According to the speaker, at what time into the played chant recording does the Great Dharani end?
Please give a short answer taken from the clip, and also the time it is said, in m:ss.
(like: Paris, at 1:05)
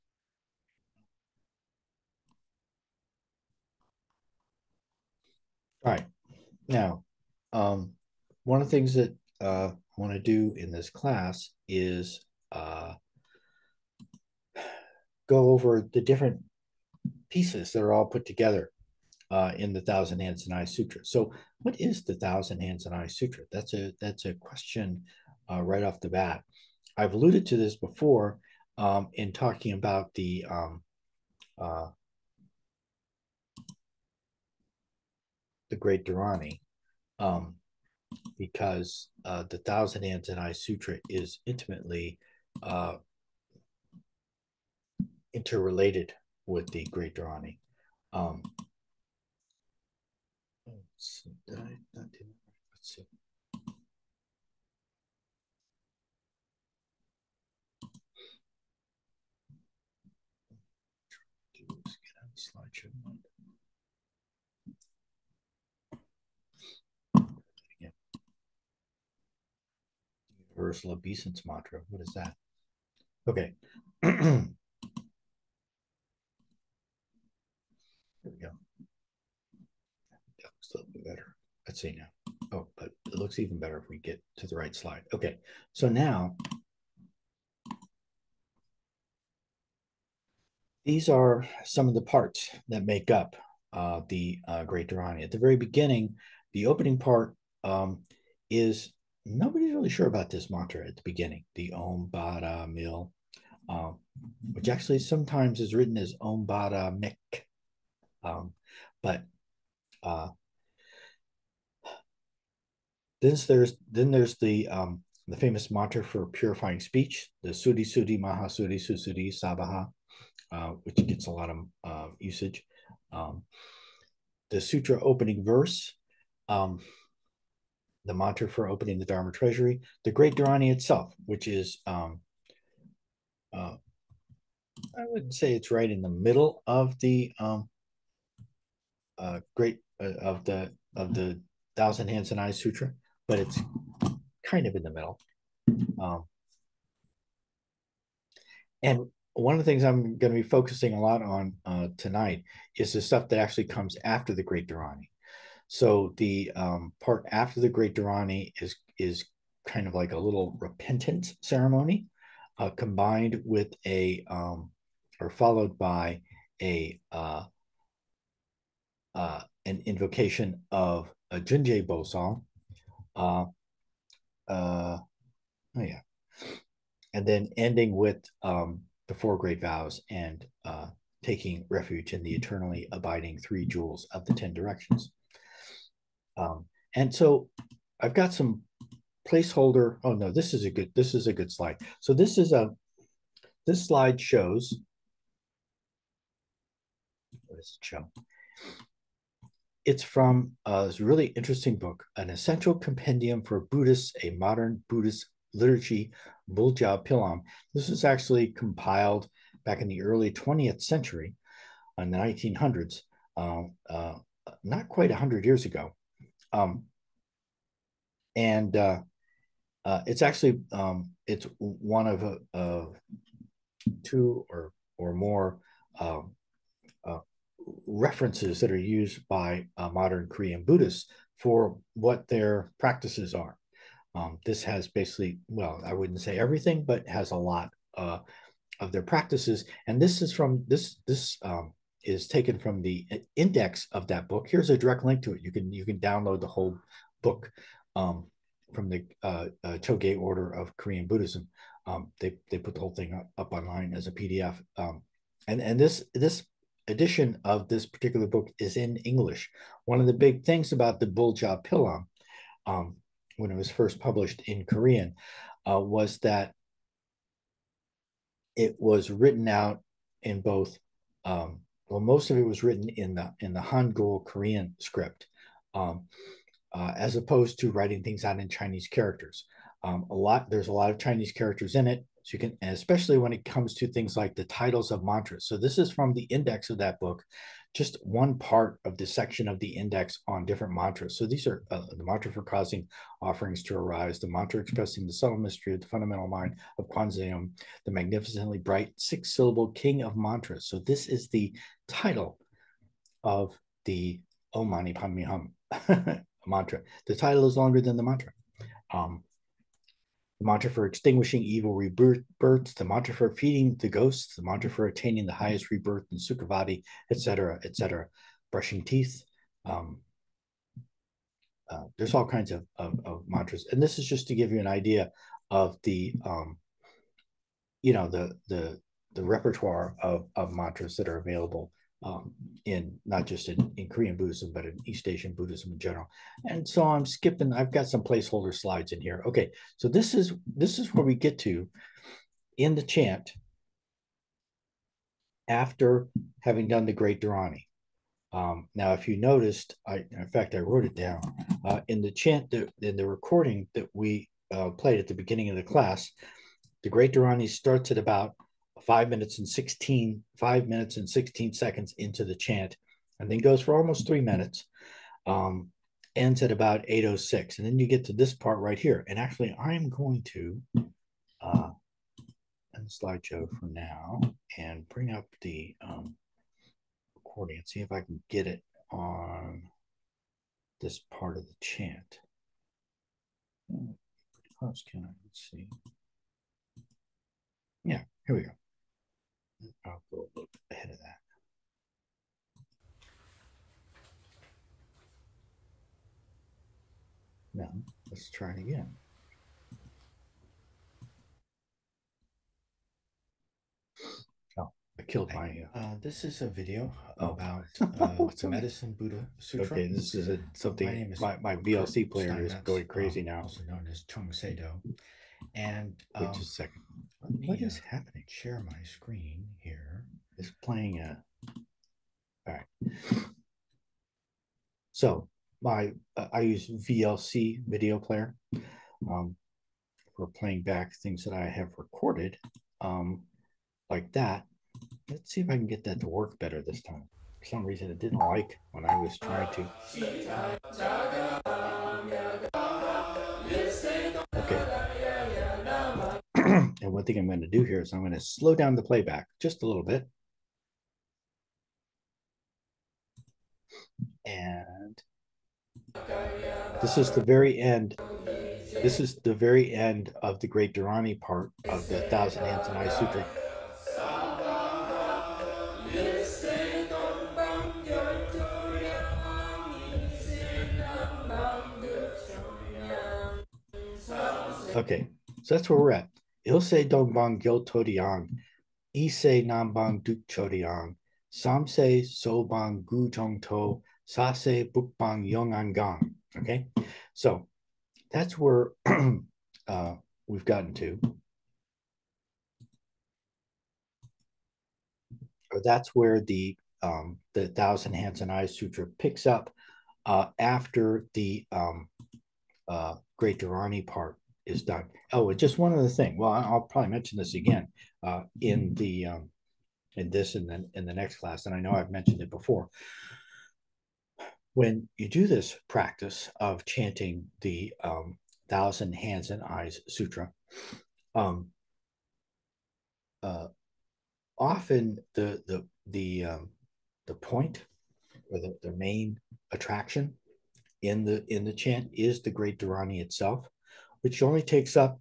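8:06, at 6:06.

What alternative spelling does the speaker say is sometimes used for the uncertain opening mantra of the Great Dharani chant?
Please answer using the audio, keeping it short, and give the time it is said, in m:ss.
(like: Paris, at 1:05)
Om Bada Mik, at 1:46.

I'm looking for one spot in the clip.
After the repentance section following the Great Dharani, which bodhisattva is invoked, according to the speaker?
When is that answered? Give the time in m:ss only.
2:51.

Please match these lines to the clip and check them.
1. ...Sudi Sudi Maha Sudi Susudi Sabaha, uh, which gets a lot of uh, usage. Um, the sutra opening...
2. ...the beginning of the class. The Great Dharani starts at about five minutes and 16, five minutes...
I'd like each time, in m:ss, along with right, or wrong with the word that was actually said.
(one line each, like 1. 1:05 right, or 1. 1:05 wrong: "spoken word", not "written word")
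1. 1:57 right
2. 5:55 right.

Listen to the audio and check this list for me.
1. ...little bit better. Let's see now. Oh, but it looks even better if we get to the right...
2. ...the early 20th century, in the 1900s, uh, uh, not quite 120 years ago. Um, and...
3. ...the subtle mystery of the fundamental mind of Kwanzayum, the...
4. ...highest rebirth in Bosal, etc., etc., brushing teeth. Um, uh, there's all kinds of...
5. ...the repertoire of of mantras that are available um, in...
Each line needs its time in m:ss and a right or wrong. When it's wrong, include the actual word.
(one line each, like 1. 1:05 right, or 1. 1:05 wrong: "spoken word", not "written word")
1. 1:20 right
2. 3:29 wrong: "100", not "120"
3. 4:55 right
4. 5:15 wrong: "Sukhavati", not "Bosal"
5. 5:29 right.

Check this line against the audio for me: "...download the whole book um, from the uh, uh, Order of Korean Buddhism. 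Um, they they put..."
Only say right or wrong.
right.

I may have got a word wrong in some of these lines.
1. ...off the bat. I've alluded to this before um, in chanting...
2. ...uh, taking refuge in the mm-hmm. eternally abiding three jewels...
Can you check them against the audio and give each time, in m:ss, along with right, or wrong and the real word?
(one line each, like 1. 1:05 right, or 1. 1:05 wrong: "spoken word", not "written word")
1. 0:25 wrong: "talking", not "chanting"
2. 3:00 right.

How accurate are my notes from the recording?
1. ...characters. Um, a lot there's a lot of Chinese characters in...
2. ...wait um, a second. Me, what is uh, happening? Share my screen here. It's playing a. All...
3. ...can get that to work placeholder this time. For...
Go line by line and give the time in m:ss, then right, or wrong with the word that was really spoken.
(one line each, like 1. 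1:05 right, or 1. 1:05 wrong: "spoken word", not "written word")
1. 4:38 right
2. 6:56 right
3. 7:15 wrong: "better", not "placeholder".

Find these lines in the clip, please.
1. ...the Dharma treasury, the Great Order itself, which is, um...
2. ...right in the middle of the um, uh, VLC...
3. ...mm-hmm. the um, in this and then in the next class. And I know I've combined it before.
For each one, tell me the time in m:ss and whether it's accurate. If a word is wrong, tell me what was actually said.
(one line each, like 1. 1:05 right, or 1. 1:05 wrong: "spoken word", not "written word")
1. 2:08 wrong: "Dharani", not "Order"
2. 2:15 wrong: "Great", not "VLC"
3. 8:28 wrong: "mentioned", not "combined".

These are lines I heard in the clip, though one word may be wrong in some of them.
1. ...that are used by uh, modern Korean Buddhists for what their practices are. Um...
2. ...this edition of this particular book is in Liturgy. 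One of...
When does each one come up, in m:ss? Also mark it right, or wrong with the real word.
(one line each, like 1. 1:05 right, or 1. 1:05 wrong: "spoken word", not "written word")
1. 3:48 right
2. 4:16 wrong: "English", not "Liturgy".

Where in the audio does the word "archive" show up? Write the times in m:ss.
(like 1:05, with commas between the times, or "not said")
not said.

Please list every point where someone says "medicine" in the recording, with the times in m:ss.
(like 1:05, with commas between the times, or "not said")
6:48.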